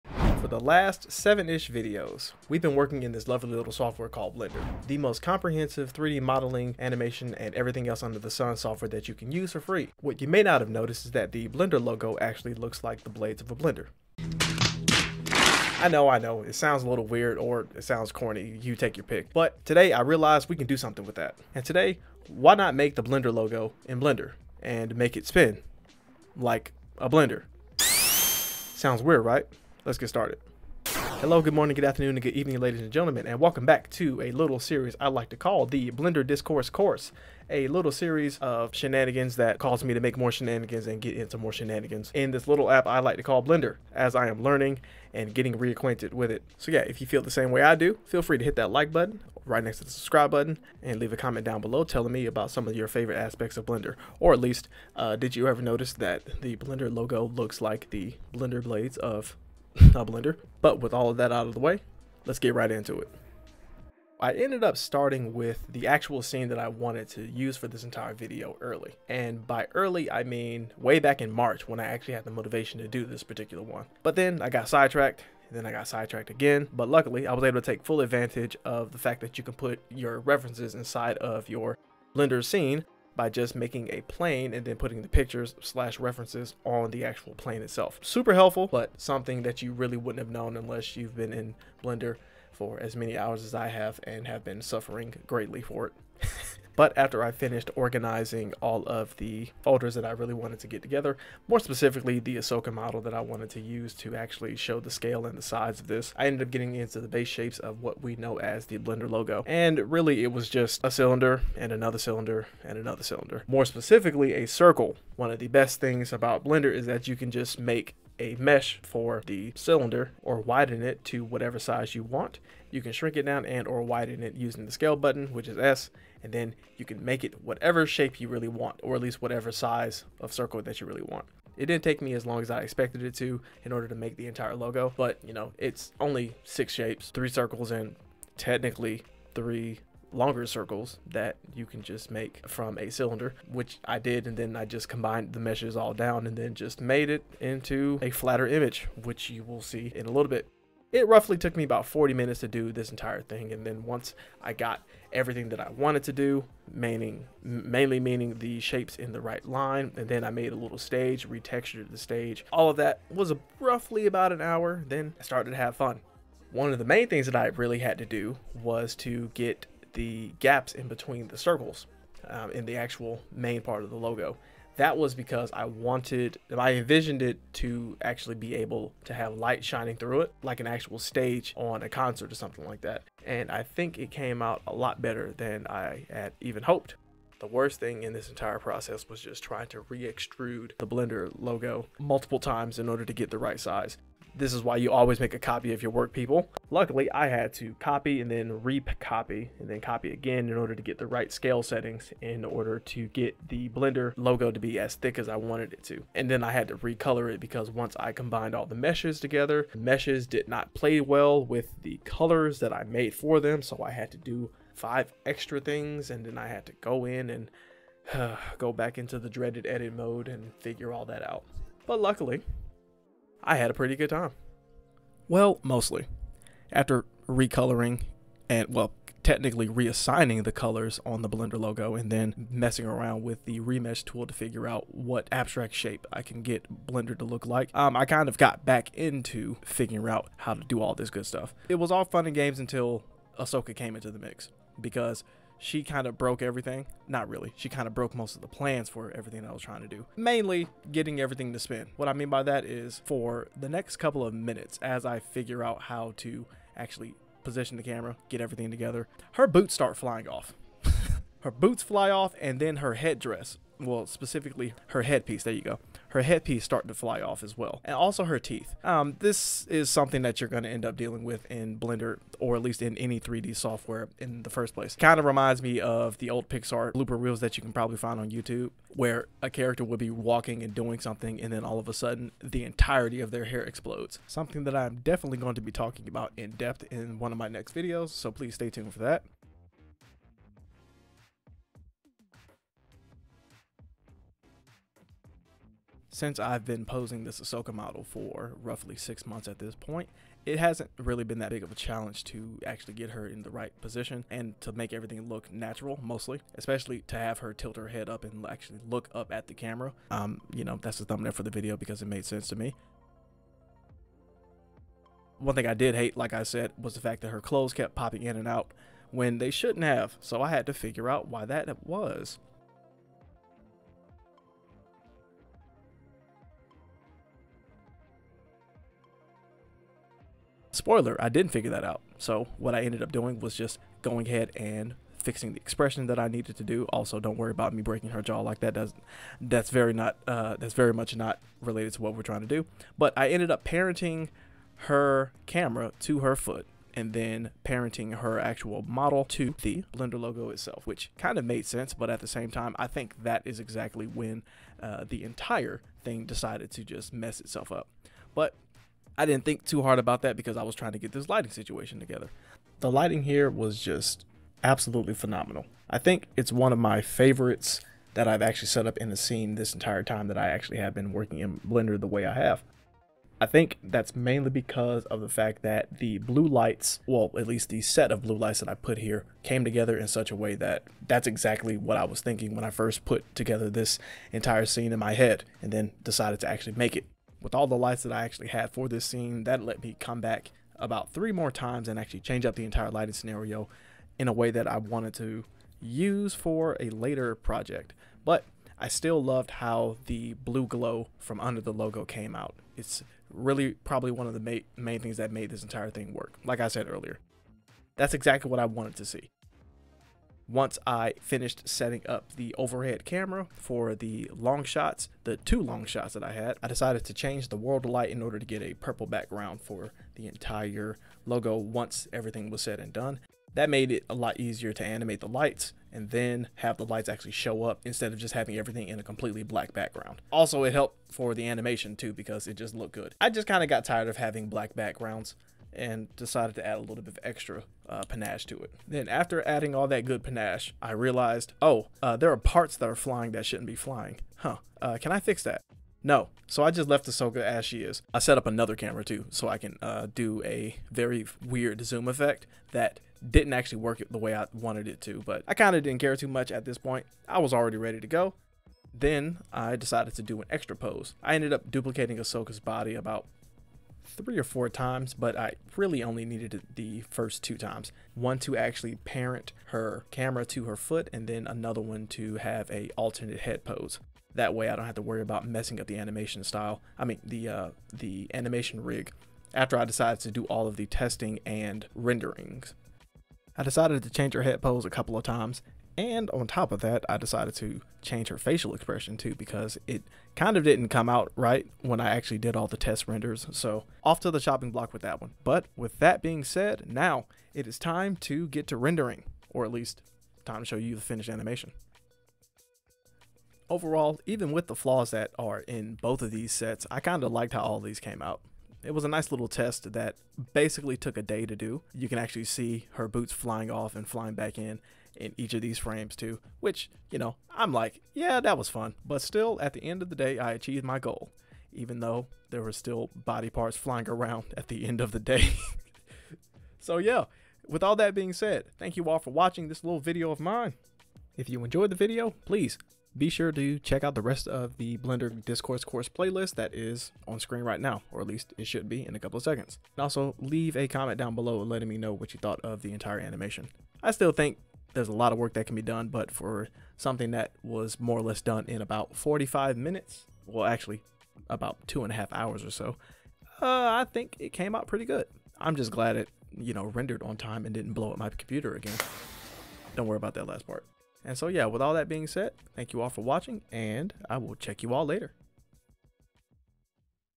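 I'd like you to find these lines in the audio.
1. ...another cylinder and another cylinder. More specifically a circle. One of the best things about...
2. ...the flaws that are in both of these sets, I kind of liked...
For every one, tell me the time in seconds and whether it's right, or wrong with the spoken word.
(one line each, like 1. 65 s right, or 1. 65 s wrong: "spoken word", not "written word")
1. 111 s right
2. 504 s right.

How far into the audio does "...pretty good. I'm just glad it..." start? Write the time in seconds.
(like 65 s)
554 s.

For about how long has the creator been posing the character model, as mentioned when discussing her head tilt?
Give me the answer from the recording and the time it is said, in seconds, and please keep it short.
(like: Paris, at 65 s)
six months, at 298 s.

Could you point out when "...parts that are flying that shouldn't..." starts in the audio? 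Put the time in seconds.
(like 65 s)
442 s.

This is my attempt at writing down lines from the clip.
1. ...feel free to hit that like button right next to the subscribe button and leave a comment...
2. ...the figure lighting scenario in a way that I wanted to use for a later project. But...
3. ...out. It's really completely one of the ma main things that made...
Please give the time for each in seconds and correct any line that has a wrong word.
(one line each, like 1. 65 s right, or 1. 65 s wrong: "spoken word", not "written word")
1. 48 s right
2. 392 s wrong: "entire", not "figure"
3. 402 s wrong: "probably", not "completely".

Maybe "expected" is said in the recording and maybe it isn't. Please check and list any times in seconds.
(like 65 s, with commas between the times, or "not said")
132 s.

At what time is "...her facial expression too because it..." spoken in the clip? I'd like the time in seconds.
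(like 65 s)
488 s.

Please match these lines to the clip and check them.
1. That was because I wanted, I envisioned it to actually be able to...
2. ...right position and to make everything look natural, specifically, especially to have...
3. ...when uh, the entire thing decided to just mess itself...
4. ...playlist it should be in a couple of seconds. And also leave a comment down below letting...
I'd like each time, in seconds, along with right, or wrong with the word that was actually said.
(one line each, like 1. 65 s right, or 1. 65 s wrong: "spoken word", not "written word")
1. 174 s right
2. 303 s wrong: "mostly", not "specifically"
3. 354 s right
4. 538 s wrong: "least", not "playlist".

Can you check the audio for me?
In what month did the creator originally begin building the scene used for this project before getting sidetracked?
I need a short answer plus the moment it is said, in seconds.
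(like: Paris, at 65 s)
March, at 71 s.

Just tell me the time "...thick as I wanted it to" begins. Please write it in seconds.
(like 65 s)
204 s.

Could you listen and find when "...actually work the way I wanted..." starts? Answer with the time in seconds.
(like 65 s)
453 s.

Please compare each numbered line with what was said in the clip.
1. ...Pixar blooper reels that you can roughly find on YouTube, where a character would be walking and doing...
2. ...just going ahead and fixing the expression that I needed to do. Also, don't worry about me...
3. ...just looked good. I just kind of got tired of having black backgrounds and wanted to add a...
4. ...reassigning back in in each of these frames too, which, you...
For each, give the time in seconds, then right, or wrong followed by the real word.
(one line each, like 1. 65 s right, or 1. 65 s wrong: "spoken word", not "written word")
1. 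276 s wrong: "probably", not "roughly"
2. 333 s right
3. 432 s wrong: "decided", not "wanted"
4. 514 s wrong: "flying", not "reassigning".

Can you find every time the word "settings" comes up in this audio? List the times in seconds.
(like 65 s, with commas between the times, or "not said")
201 s, 411 s.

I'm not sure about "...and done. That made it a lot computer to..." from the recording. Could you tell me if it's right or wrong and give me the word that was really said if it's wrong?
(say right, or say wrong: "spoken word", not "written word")
wrong: "easier", not "computer".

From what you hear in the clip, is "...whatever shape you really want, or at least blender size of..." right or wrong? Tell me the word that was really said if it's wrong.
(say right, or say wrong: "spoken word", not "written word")
wrong: "whatever", not "blender".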